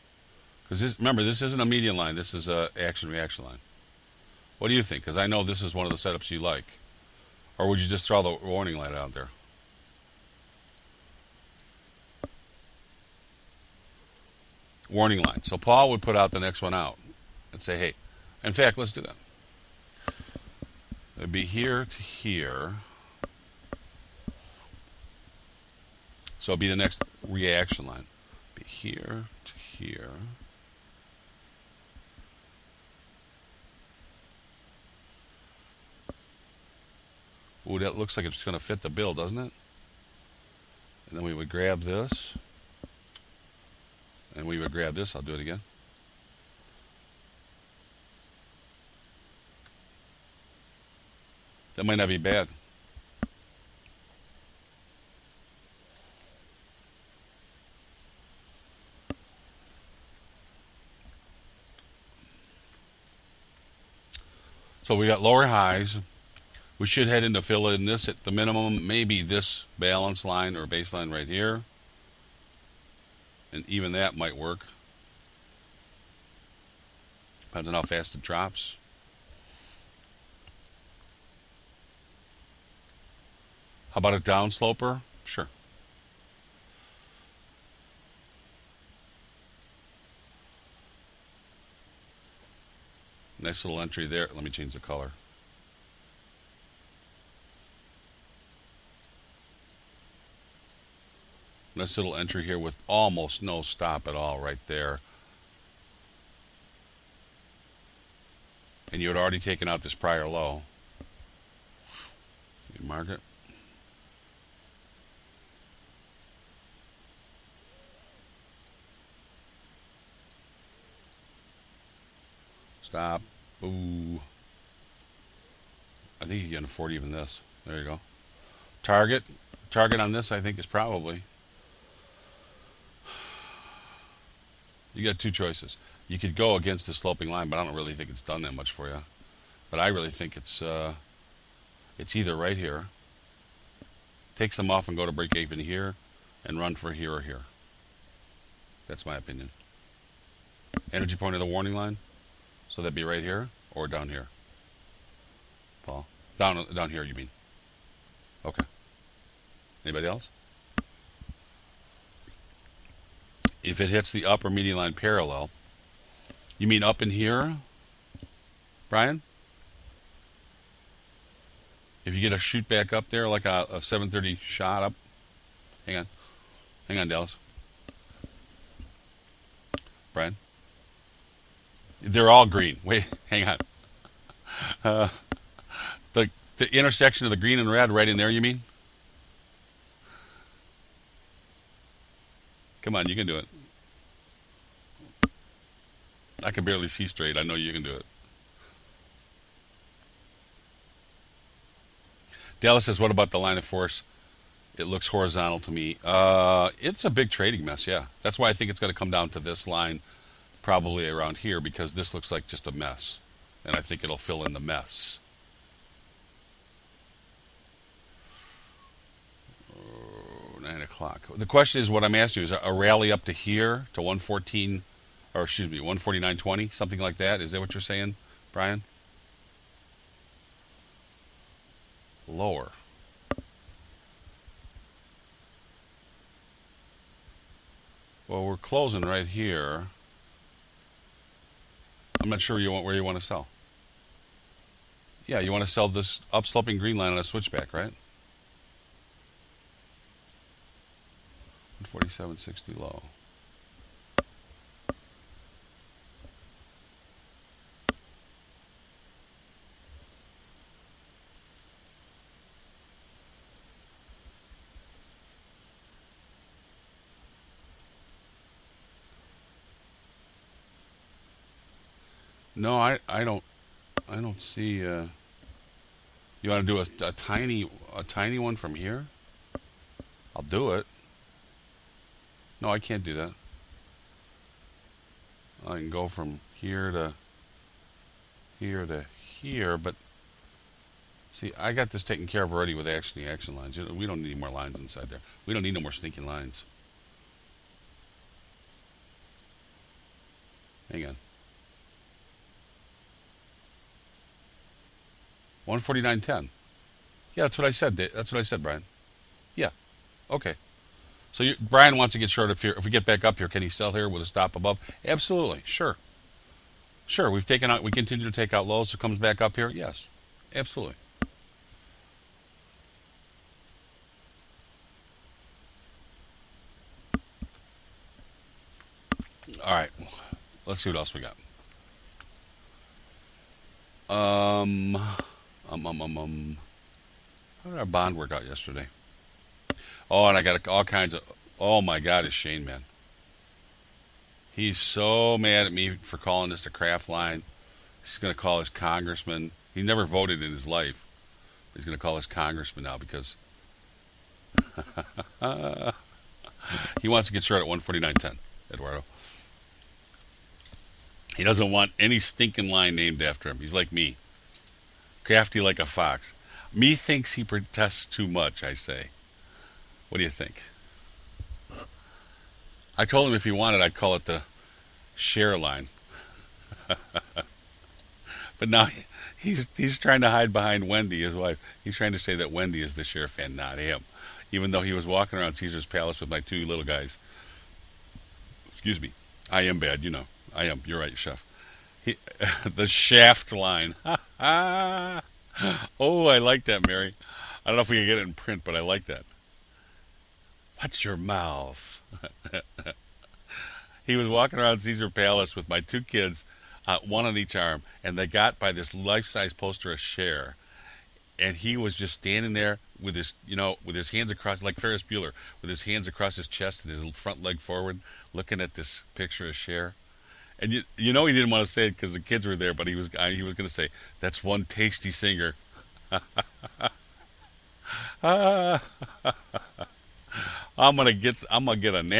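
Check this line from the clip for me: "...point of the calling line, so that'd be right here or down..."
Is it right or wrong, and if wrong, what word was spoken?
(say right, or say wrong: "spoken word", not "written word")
wrong: "warning", not "calling".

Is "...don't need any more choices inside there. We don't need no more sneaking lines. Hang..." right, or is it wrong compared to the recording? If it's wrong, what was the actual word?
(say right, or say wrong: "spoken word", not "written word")
wrong: "lines", not "choices".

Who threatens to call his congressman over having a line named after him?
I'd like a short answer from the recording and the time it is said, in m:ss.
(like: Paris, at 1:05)
Shane, at 5:42.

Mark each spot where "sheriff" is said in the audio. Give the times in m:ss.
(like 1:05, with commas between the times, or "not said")
6:23.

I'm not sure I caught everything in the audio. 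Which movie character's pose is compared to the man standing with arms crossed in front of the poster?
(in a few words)
Ferris Bueller.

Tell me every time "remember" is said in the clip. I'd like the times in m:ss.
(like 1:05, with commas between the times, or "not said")
0:00.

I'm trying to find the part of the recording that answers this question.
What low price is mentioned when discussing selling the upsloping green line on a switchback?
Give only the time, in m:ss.
4:11.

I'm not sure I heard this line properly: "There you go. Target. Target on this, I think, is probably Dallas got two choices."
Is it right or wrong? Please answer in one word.
wrong.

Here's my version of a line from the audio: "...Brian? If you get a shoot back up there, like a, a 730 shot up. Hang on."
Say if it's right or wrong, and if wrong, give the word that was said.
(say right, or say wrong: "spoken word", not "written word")
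right.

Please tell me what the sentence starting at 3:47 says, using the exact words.
Is that what you're saying, Brian?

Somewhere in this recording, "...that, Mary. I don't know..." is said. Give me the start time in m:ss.
6:36.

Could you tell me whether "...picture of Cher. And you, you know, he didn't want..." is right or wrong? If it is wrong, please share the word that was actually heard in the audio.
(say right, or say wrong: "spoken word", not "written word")
right.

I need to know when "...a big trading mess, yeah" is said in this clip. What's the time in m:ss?
3:27.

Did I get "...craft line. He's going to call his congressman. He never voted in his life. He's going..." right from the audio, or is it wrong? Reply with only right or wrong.
right.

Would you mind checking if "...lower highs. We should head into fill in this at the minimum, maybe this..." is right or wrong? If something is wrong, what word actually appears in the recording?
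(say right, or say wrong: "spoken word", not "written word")
right.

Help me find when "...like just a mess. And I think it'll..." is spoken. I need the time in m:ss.
3:32.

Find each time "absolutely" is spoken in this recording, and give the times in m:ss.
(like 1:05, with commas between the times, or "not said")
5:15, 5:20.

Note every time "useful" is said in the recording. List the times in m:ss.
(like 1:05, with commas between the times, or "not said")
not said.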